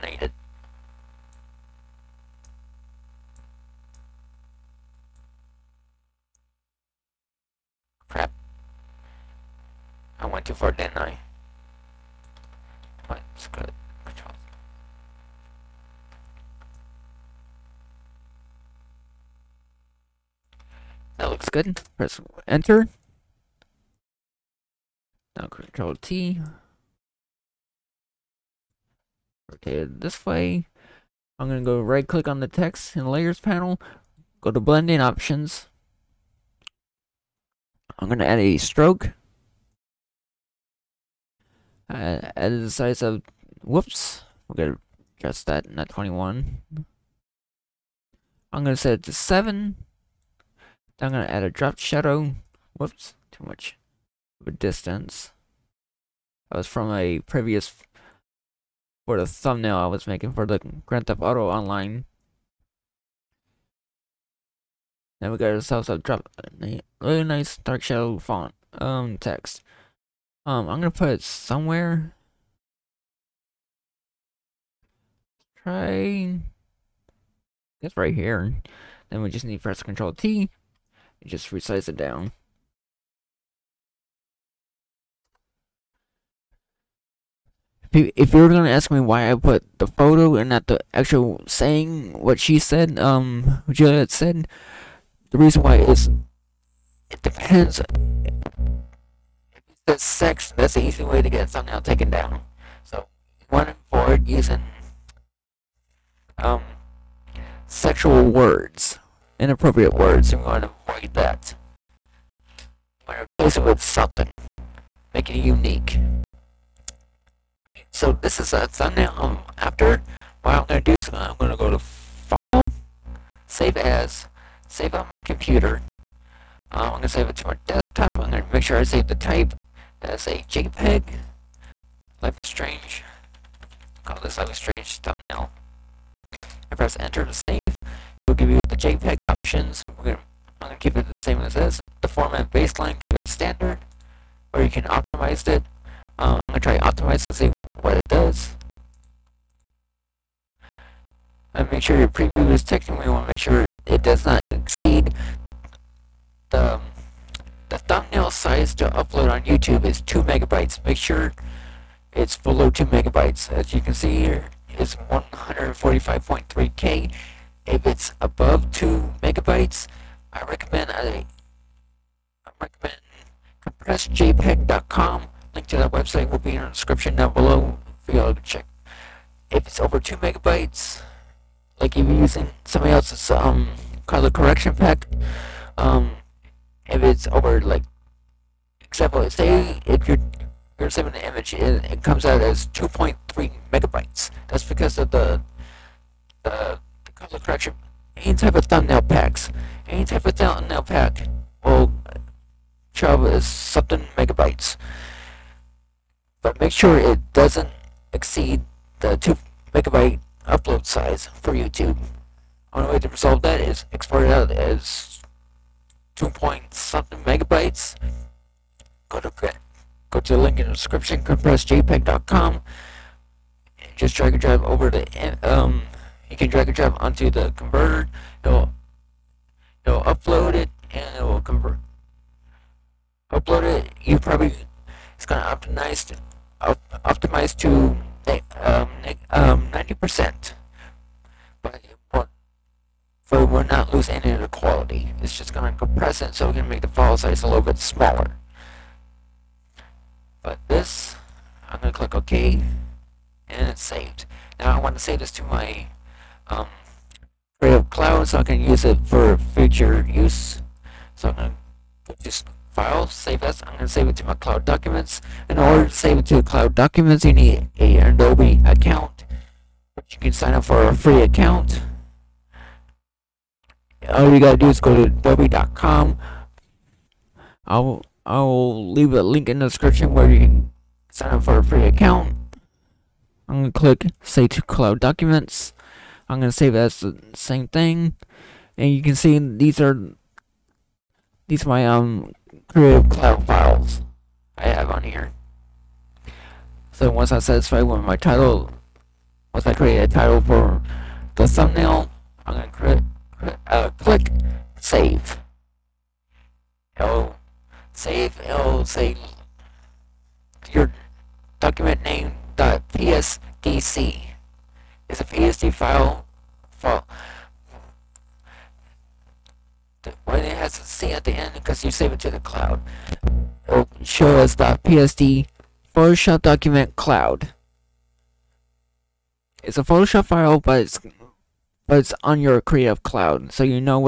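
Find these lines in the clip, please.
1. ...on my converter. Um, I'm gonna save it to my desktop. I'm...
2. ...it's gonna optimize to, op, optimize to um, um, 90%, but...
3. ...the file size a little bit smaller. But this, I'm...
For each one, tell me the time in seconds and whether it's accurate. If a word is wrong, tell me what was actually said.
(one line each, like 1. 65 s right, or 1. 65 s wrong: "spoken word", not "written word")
1. 124 s wrong: "computer", not "converter"
2. 235 s right
3. 246 s right.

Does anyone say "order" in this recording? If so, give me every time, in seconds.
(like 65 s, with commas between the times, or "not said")
265 s.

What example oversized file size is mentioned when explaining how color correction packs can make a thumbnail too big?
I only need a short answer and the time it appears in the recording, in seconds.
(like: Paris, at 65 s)
2.3 megabytes, at 192 s.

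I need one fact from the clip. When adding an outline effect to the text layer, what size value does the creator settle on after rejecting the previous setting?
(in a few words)
7.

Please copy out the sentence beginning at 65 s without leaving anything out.
Then we got ourselves a drop, a really nice dark shadow font, um, text.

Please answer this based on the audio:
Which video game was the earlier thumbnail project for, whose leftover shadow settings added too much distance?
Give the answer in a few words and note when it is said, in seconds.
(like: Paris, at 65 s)
Grand Theft Auto Online, at 60 s.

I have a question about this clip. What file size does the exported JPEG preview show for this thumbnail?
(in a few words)
145.3K.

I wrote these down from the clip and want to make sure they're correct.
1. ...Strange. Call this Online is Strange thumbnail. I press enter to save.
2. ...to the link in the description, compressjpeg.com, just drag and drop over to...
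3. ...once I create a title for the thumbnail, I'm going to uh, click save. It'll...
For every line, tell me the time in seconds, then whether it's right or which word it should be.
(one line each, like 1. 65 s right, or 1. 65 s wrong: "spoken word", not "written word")
1. 132 s wrong: "Life", not "Online"
2. 220 s right
3. 299 s right.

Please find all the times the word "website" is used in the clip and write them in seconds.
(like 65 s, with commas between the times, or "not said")
175 s.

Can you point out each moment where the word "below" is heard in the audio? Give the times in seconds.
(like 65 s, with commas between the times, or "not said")
162 s, 177 s.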